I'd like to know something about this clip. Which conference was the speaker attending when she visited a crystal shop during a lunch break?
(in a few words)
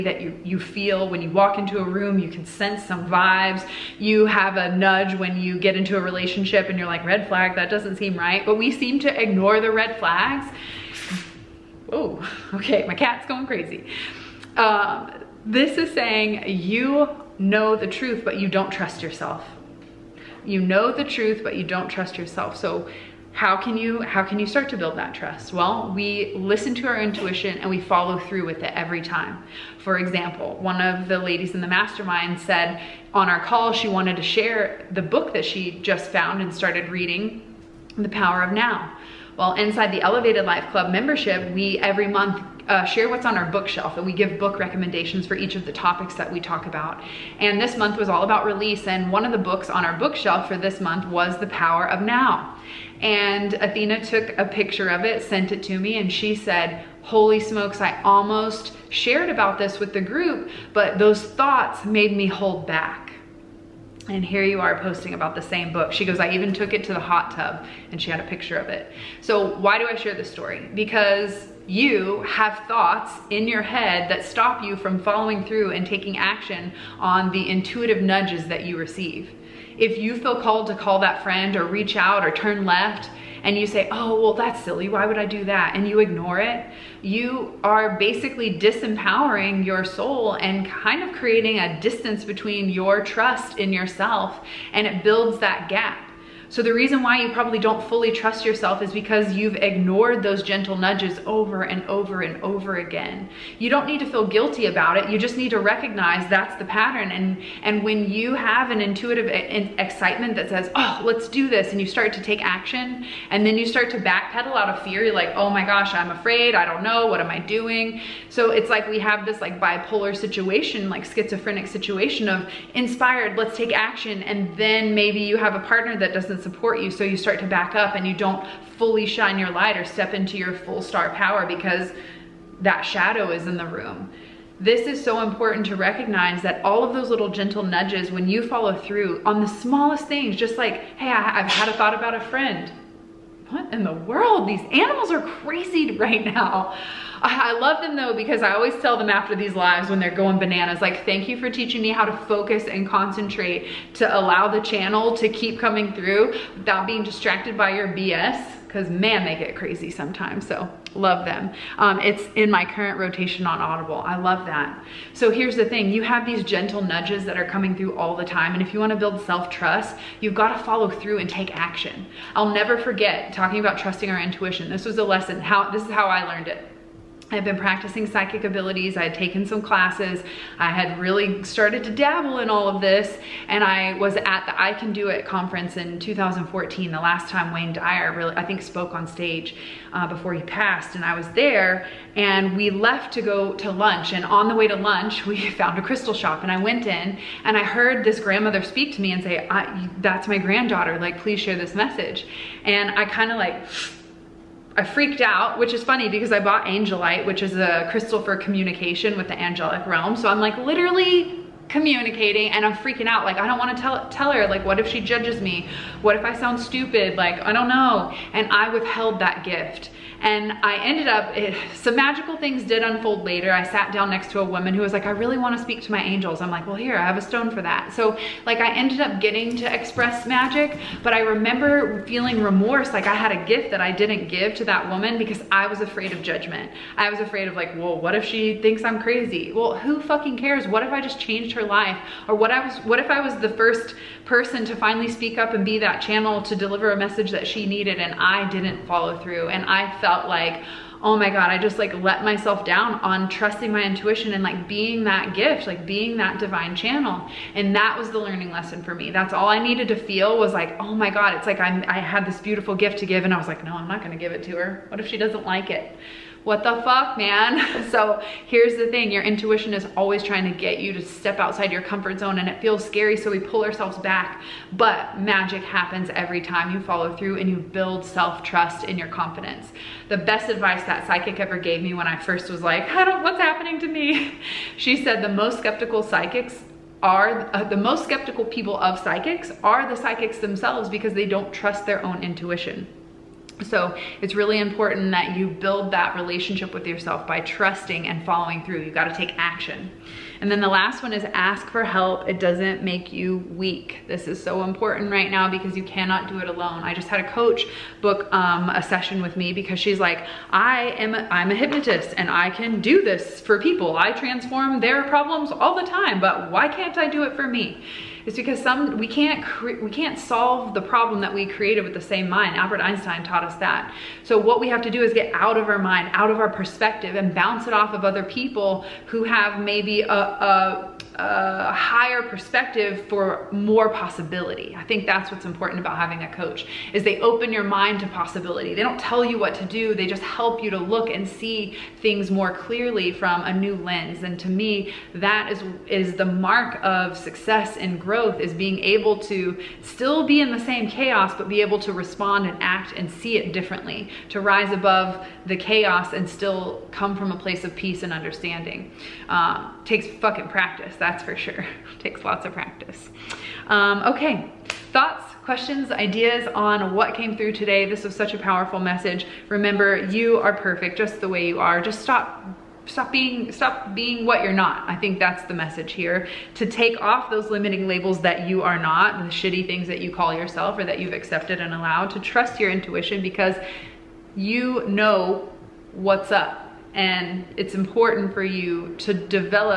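I Can Do It.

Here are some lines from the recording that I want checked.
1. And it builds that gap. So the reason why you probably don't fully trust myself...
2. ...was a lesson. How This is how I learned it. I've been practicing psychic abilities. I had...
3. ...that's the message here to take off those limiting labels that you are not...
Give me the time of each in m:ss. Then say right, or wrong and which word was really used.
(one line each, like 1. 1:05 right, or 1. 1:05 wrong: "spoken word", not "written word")
1. 1:34 wrong: "yourself", not "myself"
2. 2:54 right
3. 6:15 right.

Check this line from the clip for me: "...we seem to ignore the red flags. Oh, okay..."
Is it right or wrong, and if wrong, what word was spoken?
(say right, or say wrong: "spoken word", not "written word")
right.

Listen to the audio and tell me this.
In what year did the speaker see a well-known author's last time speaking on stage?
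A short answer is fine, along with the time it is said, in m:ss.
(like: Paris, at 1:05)
2014, at 3:05.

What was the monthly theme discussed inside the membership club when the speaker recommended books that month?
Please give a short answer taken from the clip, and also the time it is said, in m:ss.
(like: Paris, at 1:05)
Release, at 0:48.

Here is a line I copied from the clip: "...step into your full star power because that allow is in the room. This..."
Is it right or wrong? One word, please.
wrong.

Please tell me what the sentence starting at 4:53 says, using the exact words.
So it's really important that you build that relationship with yourself by trusting and following through.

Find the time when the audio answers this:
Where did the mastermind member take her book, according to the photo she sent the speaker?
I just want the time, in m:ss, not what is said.
1:06.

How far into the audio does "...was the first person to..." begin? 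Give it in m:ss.
4:03.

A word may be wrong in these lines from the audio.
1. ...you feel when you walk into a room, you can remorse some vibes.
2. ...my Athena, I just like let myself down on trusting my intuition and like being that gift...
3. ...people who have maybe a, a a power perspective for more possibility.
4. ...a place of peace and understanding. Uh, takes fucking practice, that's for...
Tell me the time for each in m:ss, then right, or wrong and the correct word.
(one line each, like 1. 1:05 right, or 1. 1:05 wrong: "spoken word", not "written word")
1. 0:00 wrong: "sense", not "remorse"
2. 4:11 wrong: "God", not "Athena"
3. 5:28 wrong: "higher", not "power"
4. 5:57 right.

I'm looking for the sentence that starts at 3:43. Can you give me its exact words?
I sat down next to a woman who was like, I really wanna speak to my angels.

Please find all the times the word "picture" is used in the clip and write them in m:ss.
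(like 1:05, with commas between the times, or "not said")
0:54, 1:08.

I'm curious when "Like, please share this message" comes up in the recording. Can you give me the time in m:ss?
3:20.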